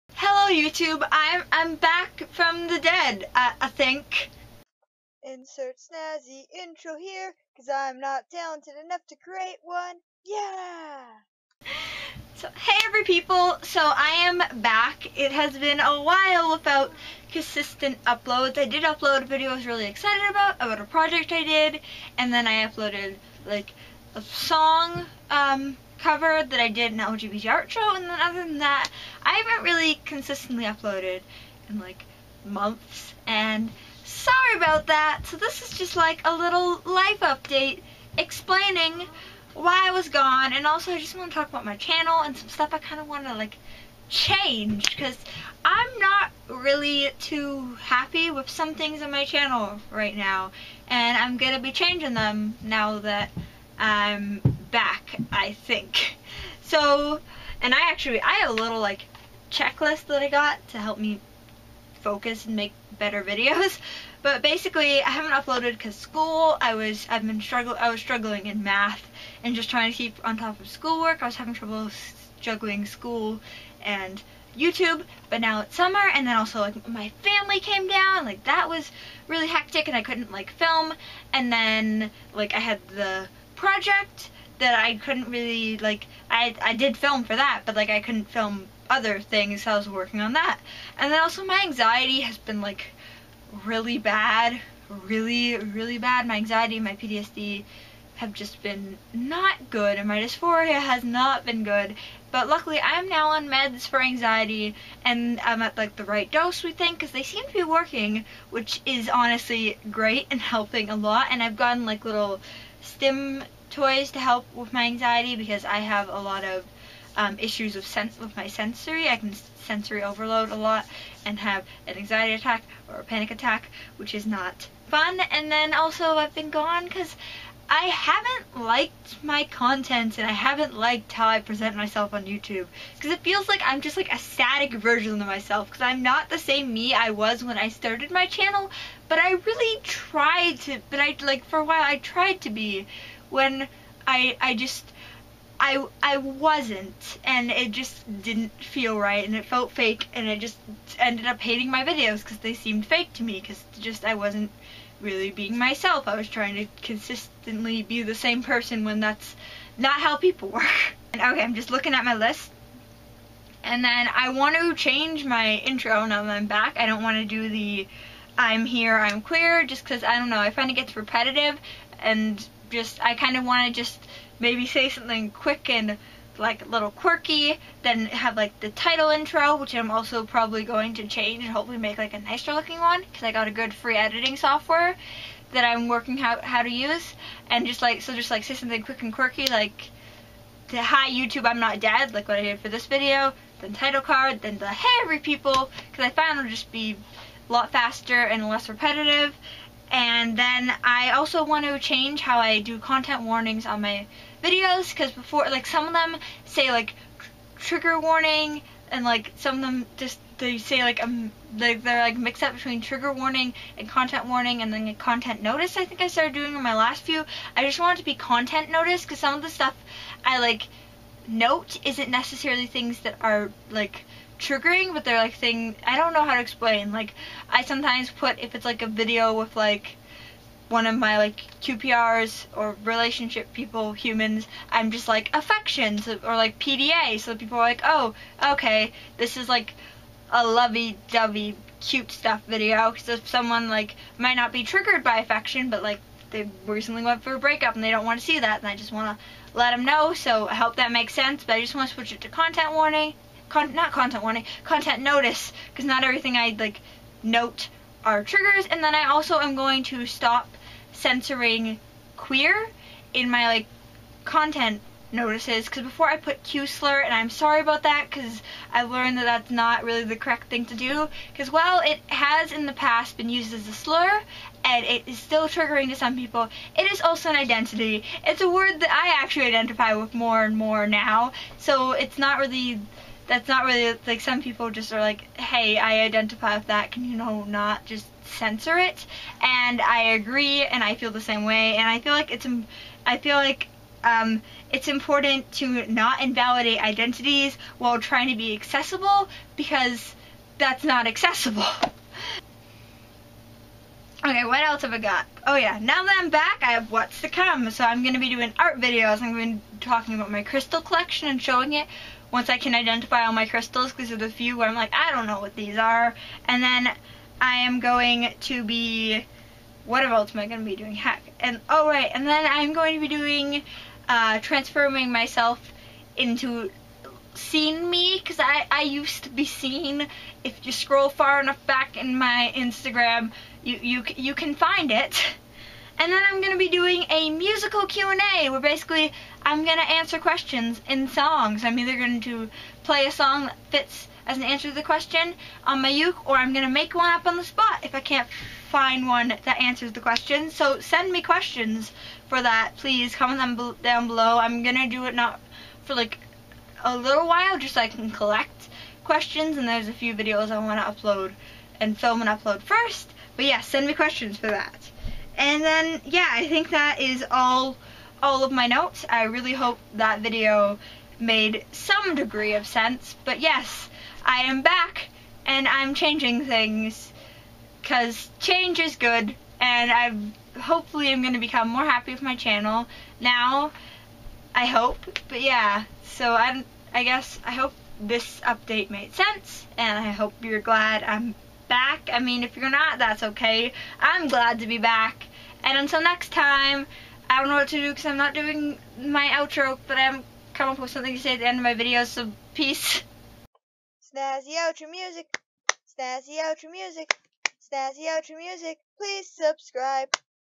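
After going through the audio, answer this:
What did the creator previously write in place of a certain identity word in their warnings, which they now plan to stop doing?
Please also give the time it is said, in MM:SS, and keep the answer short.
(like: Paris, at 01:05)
Q slur, at 04:26.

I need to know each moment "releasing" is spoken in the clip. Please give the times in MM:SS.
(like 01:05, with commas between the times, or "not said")
not said.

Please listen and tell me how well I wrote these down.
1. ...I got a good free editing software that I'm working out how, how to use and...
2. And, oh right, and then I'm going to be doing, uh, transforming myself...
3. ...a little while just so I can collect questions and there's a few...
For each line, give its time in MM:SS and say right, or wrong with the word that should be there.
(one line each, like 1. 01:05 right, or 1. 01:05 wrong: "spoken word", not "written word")
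1. 03:03 right
2. 05:21 right
3. 05:56 right.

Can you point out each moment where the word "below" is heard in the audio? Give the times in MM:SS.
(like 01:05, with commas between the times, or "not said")
05:54.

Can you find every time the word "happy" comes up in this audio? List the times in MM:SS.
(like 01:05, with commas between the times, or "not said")
00:47, 06:21.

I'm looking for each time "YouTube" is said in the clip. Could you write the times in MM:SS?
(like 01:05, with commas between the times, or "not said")
00:00, 01:14, 02:12, 03:11.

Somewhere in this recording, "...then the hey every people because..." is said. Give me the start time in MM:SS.
03:14.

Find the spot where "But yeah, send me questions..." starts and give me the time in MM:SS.
06:03.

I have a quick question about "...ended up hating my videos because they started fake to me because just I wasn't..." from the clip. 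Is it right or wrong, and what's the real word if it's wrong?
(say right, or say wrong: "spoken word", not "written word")
wrong: "seemed", not "started".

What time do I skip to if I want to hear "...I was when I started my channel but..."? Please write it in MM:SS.
02:16.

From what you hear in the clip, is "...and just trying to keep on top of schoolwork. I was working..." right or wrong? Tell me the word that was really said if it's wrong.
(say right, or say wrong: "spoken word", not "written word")
wrong: "having", not "working".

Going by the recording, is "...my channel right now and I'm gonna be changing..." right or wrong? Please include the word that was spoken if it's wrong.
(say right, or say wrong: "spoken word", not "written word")
right.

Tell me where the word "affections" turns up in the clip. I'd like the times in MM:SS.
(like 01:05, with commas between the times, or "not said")
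03:55, 04:05.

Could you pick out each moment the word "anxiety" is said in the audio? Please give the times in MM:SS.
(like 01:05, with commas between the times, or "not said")
01:31, 01:36, 01:43, 01:54, 02:01.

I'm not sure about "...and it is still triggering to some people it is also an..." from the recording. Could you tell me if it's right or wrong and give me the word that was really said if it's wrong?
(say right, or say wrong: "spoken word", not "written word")
right.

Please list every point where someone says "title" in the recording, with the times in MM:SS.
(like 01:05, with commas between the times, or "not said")
02:58, 03:13.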